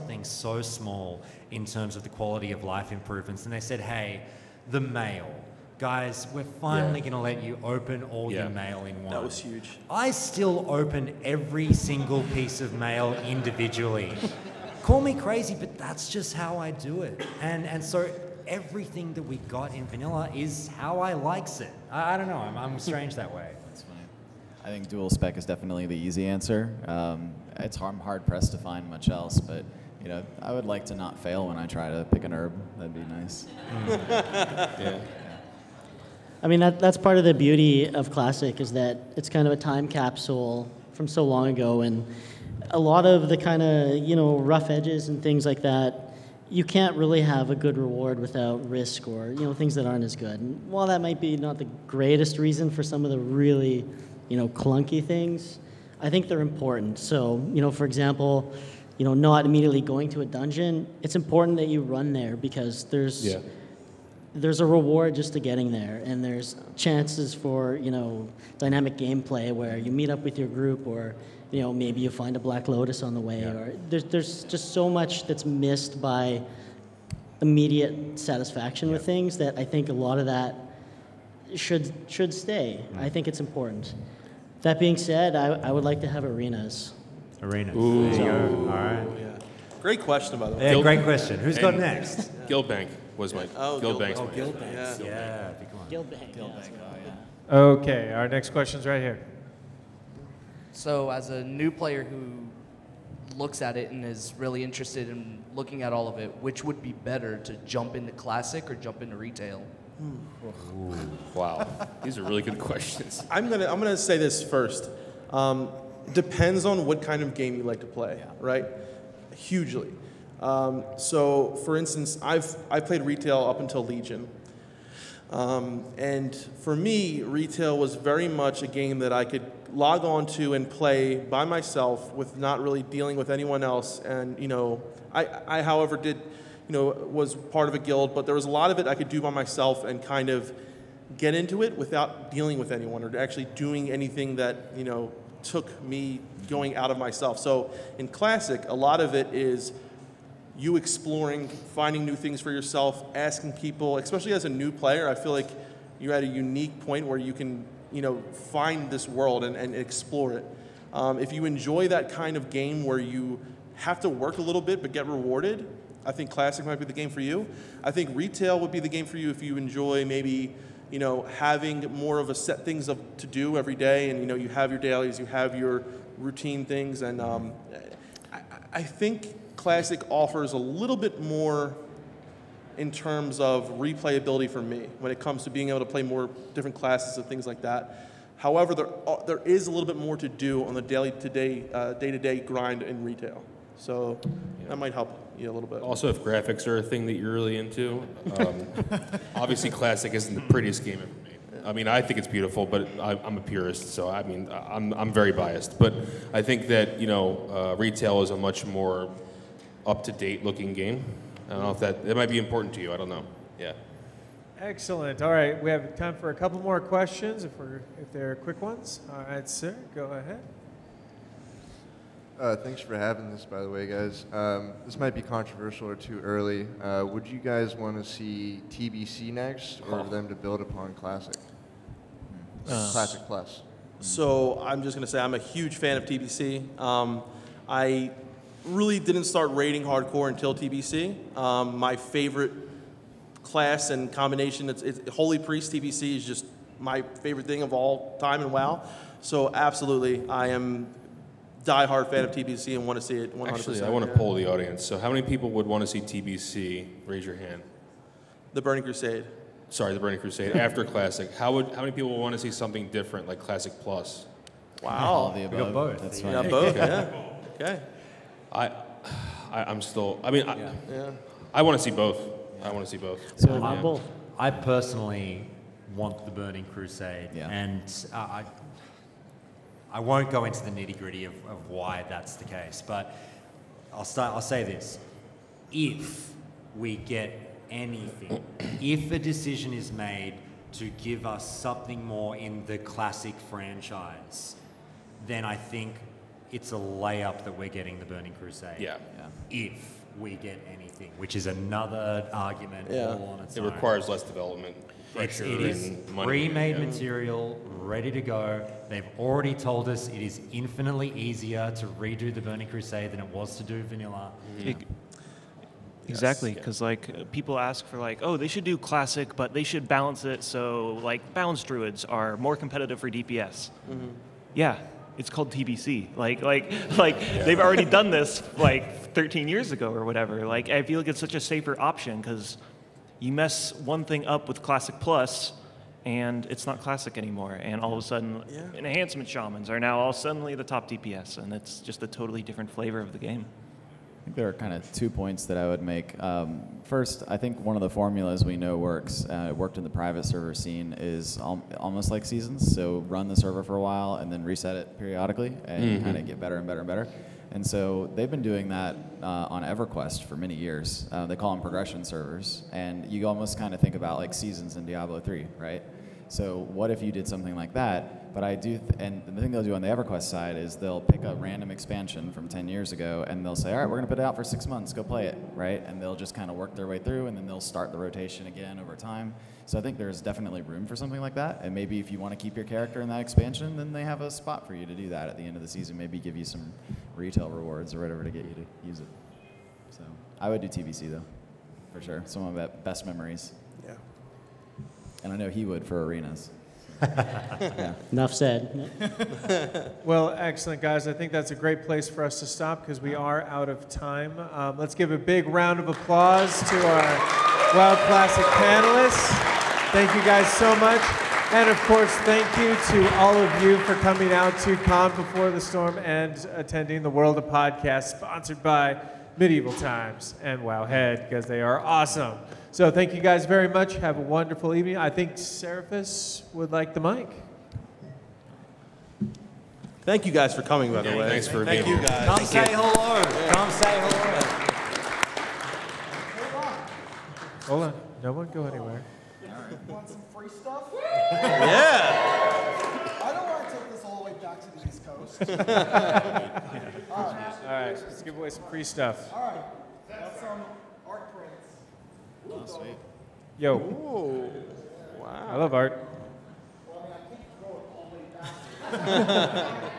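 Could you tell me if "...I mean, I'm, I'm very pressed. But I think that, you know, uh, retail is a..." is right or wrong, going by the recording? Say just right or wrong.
wrong.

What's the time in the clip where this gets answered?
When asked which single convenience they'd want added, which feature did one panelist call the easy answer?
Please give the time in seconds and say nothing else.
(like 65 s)
24 s.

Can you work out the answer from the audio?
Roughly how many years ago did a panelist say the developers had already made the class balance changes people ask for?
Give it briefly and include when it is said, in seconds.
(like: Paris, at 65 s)
13, at 329 s.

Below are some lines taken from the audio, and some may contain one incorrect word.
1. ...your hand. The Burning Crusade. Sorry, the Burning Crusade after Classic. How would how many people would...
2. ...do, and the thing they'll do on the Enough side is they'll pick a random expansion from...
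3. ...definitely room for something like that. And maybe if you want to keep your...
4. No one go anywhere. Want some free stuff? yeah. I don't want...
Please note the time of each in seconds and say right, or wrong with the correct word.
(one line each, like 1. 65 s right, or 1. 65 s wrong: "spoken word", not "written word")
1. 257 s right
2. 368 s wrong: "EverQuest", not "Enough"
3. 380 s right
4. 438 s right.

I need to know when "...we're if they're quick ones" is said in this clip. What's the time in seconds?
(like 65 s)
217 s.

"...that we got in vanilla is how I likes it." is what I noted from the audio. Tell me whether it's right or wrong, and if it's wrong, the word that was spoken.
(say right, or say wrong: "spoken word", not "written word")
right.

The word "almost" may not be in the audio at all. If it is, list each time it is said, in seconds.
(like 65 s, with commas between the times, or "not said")
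351 s, 363 s.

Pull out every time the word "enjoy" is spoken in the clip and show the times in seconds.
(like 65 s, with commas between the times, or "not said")
161 s, 169 s.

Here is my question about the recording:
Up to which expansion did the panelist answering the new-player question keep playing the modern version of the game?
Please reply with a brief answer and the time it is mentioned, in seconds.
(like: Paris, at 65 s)
Legion, at 123 s.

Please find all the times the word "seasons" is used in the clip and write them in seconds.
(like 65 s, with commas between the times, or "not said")
352 s, 364 s, 385 s.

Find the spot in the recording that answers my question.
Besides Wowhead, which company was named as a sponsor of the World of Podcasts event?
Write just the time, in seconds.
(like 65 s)
419 s.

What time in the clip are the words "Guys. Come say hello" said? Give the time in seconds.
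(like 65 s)
432 s.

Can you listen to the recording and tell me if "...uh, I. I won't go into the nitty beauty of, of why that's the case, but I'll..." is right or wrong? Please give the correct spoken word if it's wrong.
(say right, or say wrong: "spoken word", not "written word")
wrong: "gritty", not "beauty".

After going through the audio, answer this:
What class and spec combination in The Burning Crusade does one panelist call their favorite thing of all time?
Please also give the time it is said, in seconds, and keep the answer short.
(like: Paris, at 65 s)
Holy Priest, at 245 s.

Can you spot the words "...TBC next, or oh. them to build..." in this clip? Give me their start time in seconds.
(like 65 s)
228 s.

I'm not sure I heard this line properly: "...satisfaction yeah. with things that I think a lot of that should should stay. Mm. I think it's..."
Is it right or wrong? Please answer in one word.
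right.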